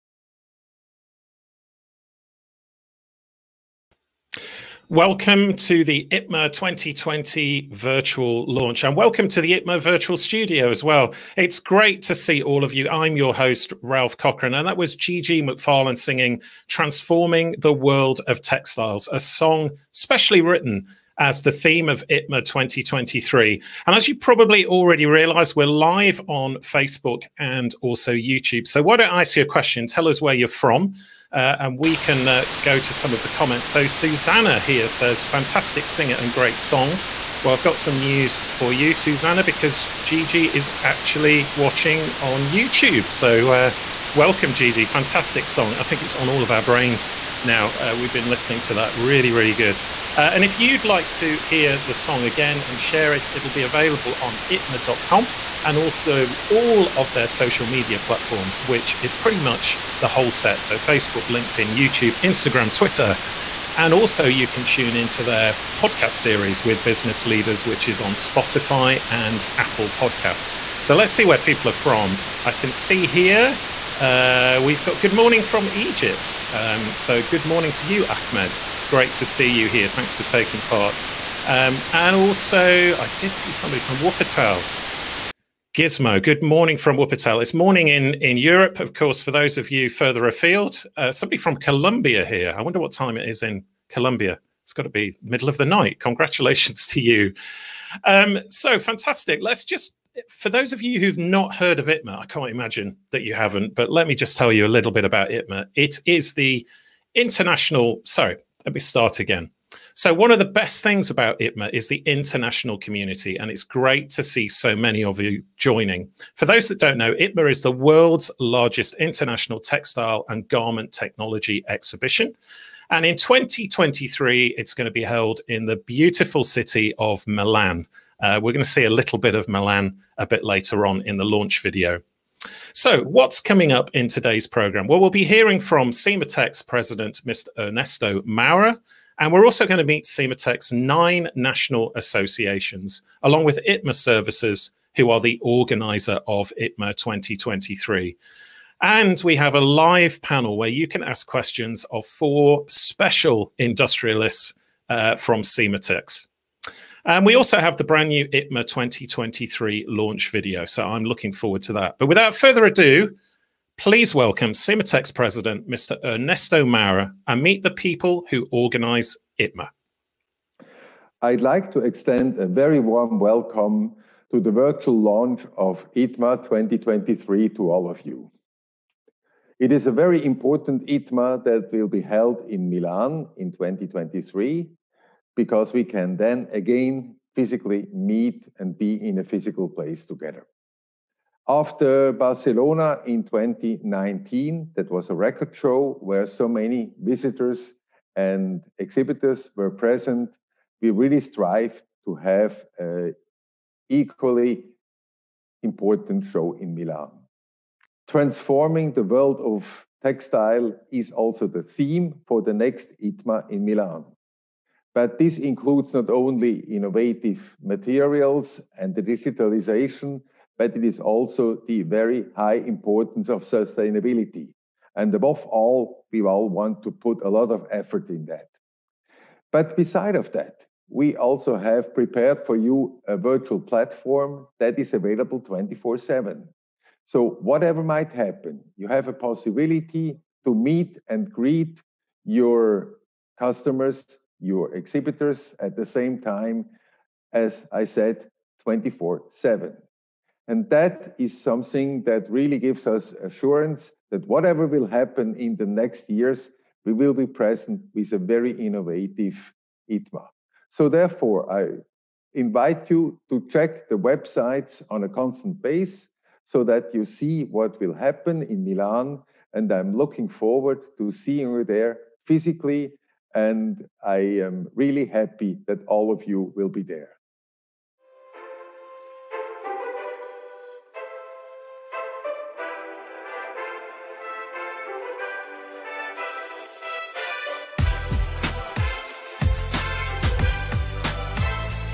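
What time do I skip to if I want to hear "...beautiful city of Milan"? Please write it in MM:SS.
02:05.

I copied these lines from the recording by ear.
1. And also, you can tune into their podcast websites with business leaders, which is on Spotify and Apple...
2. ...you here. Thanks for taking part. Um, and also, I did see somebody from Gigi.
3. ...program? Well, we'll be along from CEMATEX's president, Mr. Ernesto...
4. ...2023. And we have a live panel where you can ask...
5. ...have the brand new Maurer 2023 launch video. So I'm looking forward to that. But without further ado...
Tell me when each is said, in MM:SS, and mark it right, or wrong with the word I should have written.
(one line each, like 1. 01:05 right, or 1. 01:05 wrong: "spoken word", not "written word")
1. 01:03 wrong: "series", not "websites"
2. 01:19 wrong: "Wuppertal", not "Gigi"
3. 02:14 wrong: "hearing", not "along"
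4. 02:26 right
5. 02:37 wrong: "ITMA", not "Maurer".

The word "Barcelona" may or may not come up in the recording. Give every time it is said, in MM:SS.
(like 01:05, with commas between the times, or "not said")
03:12.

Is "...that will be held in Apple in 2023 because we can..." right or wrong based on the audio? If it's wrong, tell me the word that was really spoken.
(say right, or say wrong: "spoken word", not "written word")
wrong: "Milan", not "Apple".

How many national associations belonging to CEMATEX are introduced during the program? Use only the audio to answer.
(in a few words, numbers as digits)
9.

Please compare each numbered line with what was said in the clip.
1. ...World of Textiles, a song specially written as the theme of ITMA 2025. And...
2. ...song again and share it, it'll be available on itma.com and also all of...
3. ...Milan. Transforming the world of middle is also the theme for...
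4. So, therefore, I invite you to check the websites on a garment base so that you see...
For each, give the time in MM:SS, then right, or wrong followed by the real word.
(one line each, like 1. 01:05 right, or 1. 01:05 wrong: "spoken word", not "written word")
1. 00:17 wrong: "2023", not "2025"
2. 00:51 right
3. 03:26 wrong: "textile", not "middle"
4. 04:20 wrong: "constant", not "garment".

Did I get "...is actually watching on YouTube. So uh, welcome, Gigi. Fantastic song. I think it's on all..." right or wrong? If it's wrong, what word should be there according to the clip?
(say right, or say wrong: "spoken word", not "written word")
right.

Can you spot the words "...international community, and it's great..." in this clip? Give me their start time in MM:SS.
01:52.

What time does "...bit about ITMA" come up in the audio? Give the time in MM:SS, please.
01:44.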